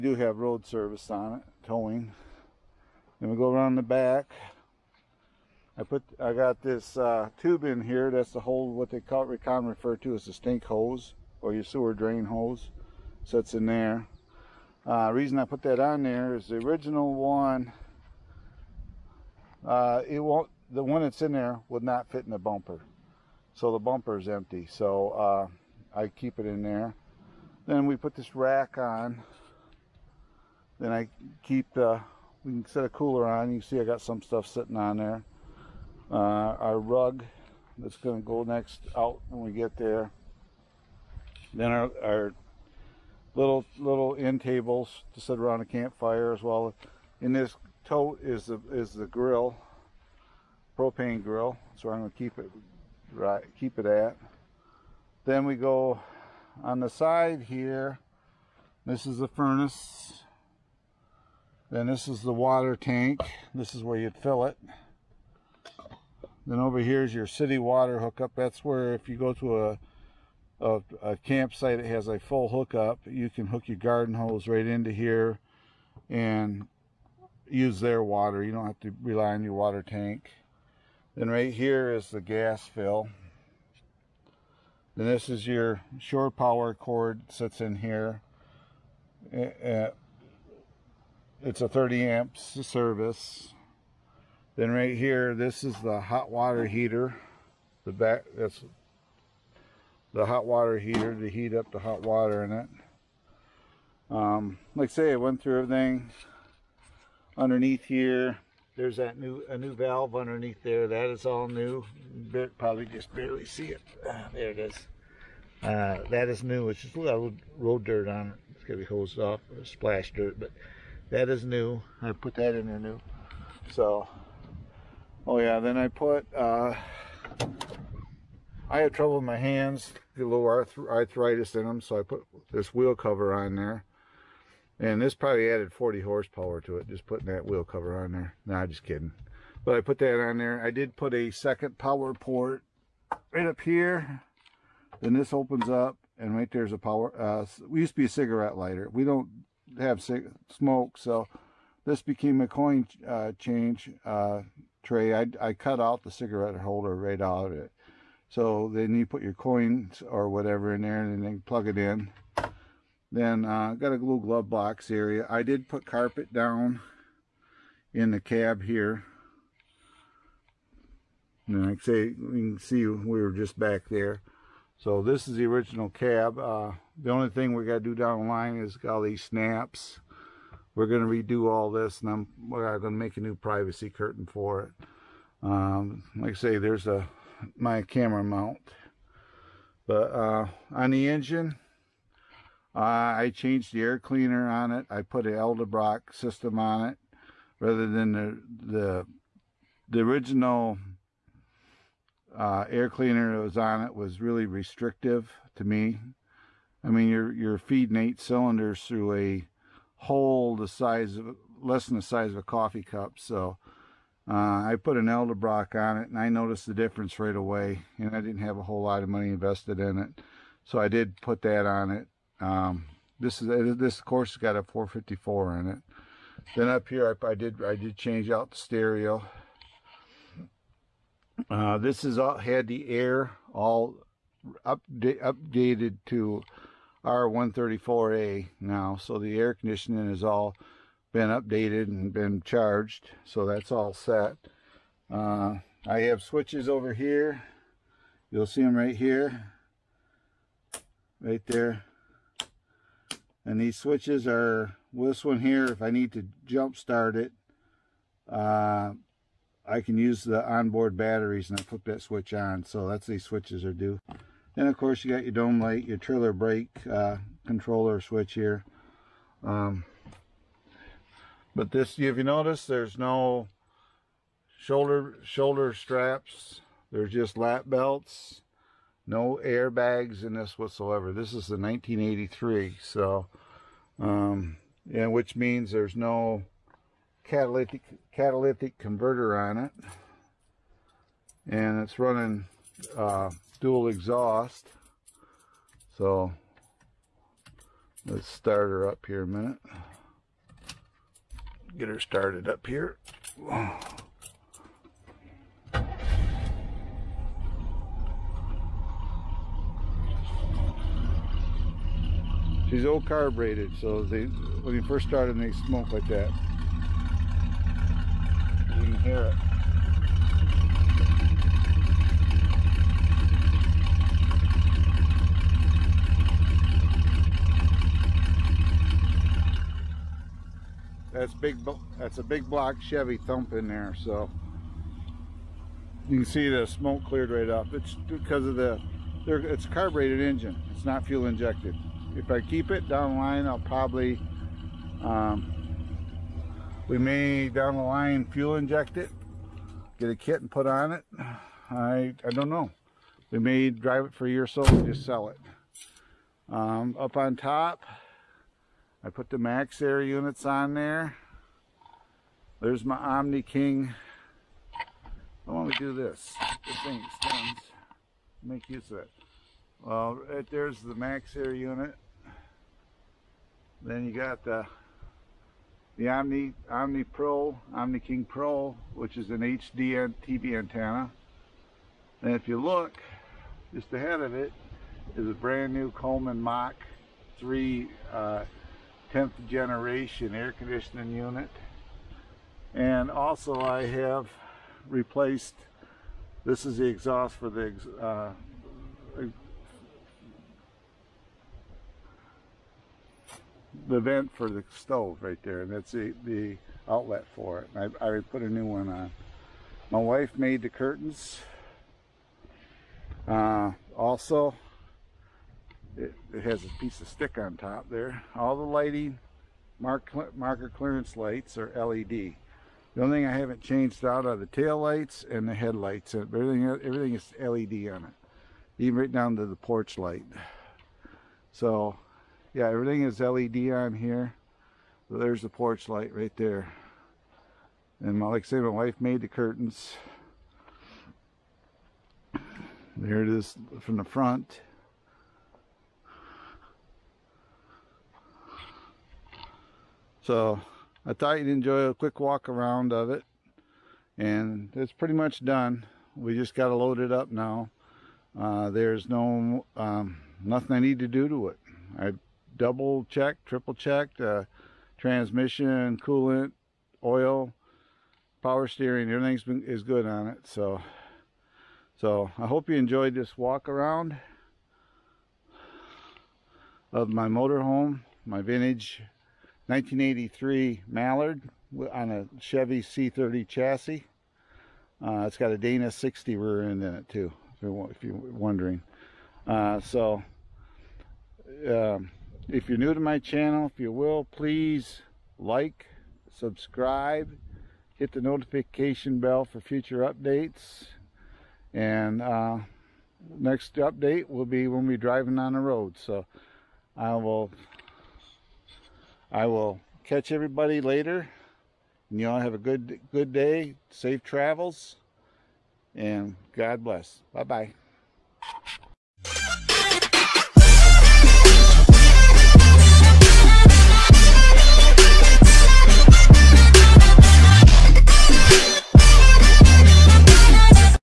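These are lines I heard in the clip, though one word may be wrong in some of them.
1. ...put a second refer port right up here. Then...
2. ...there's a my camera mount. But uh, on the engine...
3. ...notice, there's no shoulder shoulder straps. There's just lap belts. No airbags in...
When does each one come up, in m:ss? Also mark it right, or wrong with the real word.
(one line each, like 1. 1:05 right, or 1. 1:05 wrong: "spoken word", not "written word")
1. 2:20 wrong: "power", not "refer"
2. 3:06 right
3. 4:32 right.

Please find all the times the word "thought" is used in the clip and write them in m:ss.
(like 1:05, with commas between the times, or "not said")
7:31.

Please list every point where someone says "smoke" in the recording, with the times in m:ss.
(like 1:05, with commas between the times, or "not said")
2:30, 5:15, 5:36.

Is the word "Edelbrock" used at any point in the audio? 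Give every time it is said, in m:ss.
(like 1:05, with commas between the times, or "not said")
3:15, 3:35.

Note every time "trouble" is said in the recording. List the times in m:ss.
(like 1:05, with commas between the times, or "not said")
2:08.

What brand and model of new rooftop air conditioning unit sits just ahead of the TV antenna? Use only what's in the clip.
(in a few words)
Coleman Mach 3.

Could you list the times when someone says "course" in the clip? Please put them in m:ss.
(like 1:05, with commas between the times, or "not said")
3:44, 4:24.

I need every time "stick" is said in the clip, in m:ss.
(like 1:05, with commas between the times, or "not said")
6:57.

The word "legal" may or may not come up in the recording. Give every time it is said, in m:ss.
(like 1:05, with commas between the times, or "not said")
not said.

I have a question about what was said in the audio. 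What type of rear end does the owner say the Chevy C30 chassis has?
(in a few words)
Dana 60.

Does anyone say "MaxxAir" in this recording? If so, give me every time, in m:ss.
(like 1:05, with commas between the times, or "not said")
5:59, 6:10.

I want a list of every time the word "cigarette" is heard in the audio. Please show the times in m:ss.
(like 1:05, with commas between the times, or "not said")
2:28, 2:36.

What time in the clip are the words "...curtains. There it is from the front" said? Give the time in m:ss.
7:19.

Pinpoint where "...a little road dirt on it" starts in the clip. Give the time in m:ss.
1:56.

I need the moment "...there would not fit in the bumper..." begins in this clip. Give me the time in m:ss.
0:21.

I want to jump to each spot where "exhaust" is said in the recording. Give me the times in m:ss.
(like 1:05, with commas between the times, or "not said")
4:53, 6:36.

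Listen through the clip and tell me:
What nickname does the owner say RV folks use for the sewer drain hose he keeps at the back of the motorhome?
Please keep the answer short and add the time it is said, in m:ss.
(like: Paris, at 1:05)
stink hose, at 0:10.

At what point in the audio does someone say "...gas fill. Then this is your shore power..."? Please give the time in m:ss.
1:22.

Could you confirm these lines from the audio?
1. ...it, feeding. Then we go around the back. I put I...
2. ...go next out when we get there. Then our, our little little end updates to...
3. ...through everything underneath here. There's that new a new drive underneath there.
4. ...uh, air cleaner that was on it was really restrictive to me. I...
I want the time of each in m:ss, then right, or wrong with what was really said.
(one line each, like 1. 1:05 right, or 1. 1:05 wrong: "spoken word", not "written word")
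1. 0:01 wrong: "towing", not "feeding"
2. 0:38 wrong: "tables", not "updates"
3. 1:45 wrong: "valve", not "drive"
4. 3:22 right.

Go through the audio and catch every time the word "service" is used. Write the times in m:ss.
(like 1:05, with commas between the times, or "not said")
0:00, 1:32.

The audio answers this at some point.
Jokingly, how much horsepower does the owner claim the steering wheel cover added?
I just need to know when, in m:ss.
2:15.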